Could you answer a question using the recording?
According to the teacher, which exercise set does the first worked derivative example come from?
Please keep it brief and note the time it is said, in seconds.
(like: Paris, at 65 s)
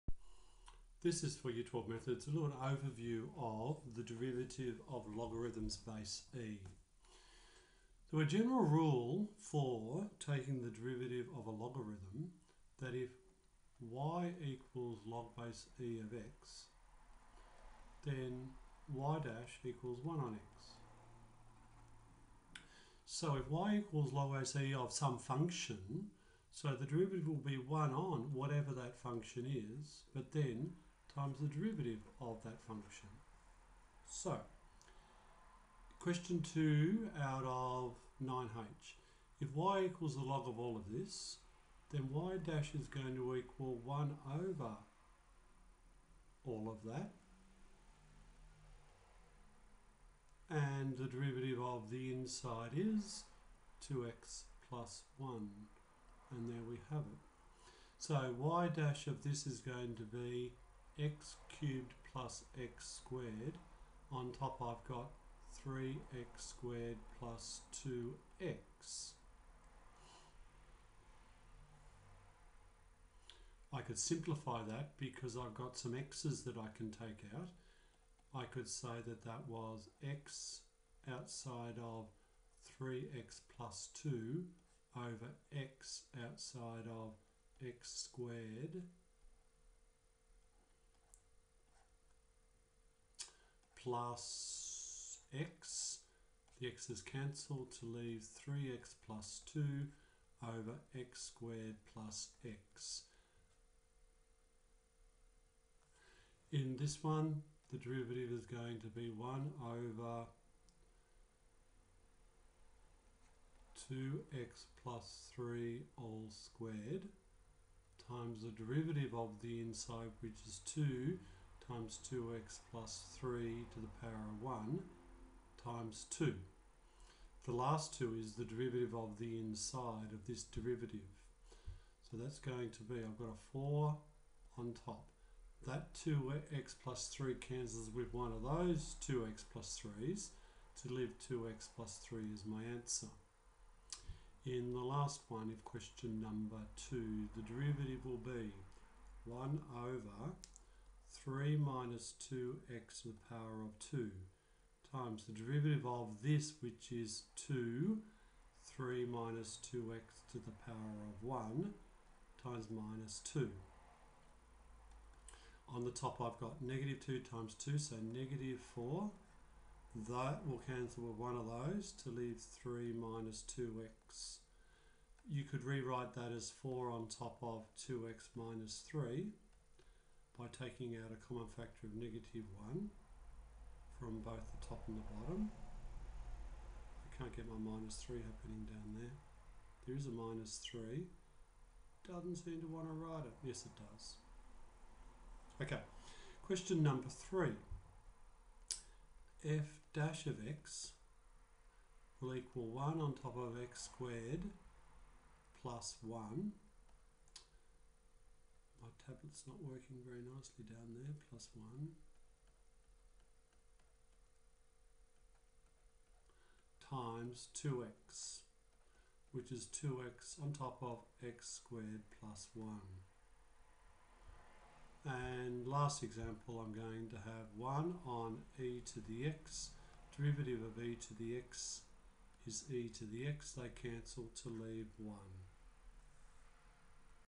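9h, at 38 s.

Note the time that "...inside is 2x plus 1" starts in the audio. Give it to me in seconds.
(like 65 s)
52 s.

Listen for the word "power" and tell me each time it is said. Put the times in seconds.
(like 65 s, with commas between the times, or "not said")
124 s, 153 s, 160 s.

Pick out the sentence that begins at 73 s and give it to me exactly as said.
I could simplify that because I've got some x's that I can take out.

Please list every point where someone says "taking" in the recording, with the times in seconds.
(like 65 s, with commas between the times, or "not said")
10 s, 180 s.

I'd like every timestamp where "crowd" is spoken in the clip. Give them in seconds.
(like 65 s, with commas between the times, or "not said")
not said.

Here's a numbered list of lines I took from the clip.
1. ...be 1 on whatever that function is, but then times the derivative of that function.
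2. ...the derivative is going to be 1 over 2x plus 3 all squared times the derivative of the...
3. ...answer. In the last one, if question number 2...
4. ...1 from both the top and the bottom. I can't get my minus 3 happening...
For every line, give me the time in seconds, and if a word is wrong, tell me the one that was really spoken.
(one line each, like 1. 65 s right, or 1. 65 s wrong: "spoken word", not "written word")
1. 27 s right
2. 107 s right
3. 142 s right
4. 182 s right.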